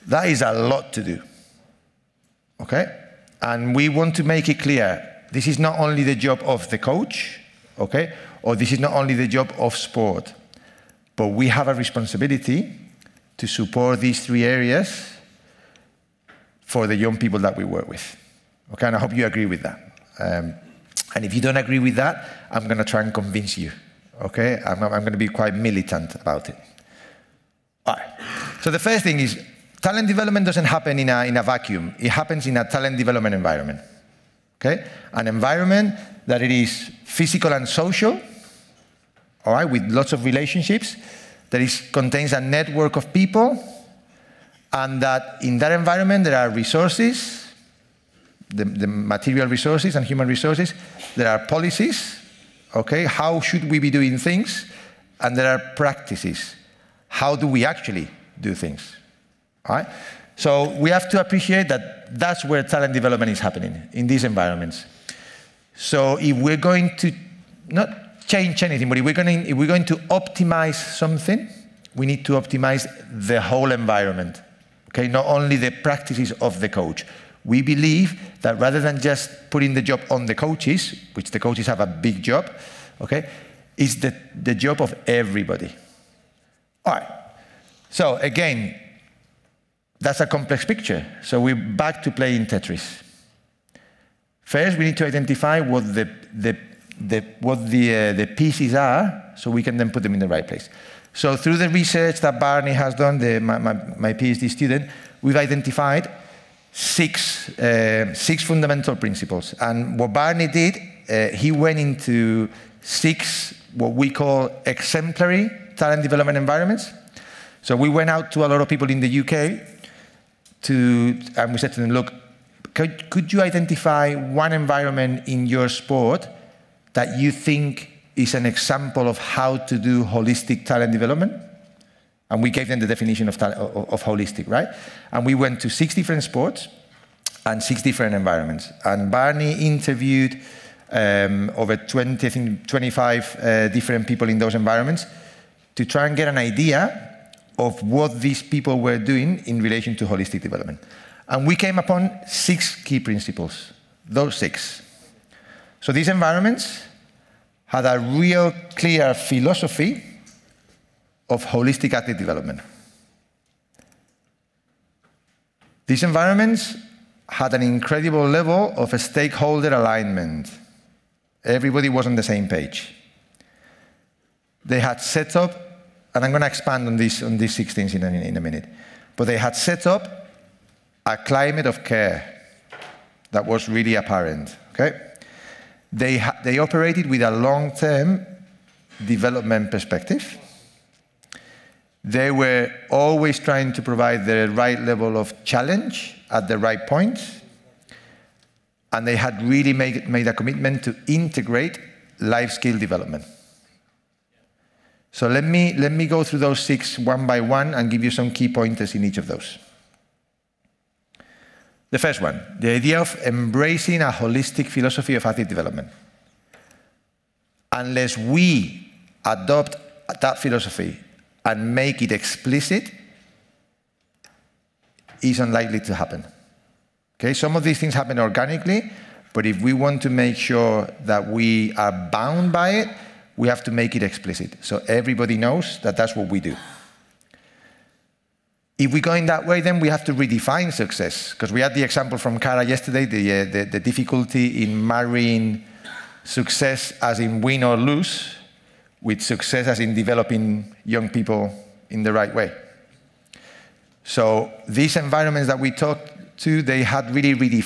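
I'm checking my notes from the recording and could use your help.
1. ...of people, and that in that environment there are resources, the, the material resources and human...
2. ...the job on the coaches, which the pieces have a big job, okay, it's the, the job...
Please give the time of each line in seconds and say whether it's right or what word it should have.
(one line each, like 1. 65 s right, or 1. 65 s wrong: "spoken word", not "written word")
1. 42 s right
2. 79 s wrong: "coaches", not "pieces".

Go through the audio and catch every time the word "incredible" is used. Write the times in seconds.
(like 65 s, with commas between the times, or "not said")
167 s.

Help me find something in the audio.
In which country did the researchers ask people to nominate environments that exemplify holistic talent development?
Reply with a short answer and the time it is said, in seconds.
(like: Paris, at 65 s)
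UK, at 119 s.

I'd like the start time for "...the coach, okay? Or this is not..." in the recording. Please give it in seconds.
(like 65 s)
6 s.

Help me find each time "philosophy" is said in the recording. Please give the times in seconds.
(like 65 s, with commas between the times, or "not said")
159 s, 214 s, 220 s.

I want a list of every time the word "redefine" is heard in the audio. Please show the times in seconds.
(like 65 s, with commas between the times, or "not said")
240 s.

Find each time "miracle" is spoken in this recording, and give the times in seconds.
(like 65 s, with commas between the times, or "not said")
not said.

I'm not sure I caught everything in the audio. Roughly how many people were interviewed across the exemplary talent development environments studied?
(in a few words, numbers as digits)
25.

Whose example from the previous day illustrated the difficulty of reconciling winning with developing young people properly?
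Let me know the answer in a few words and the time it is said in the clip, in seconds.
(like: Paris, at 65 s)
Cara, at 242 s.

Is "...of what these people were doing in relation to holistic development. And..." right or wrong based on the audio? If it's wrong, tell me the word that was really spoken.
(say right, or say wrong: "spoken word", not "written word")
right.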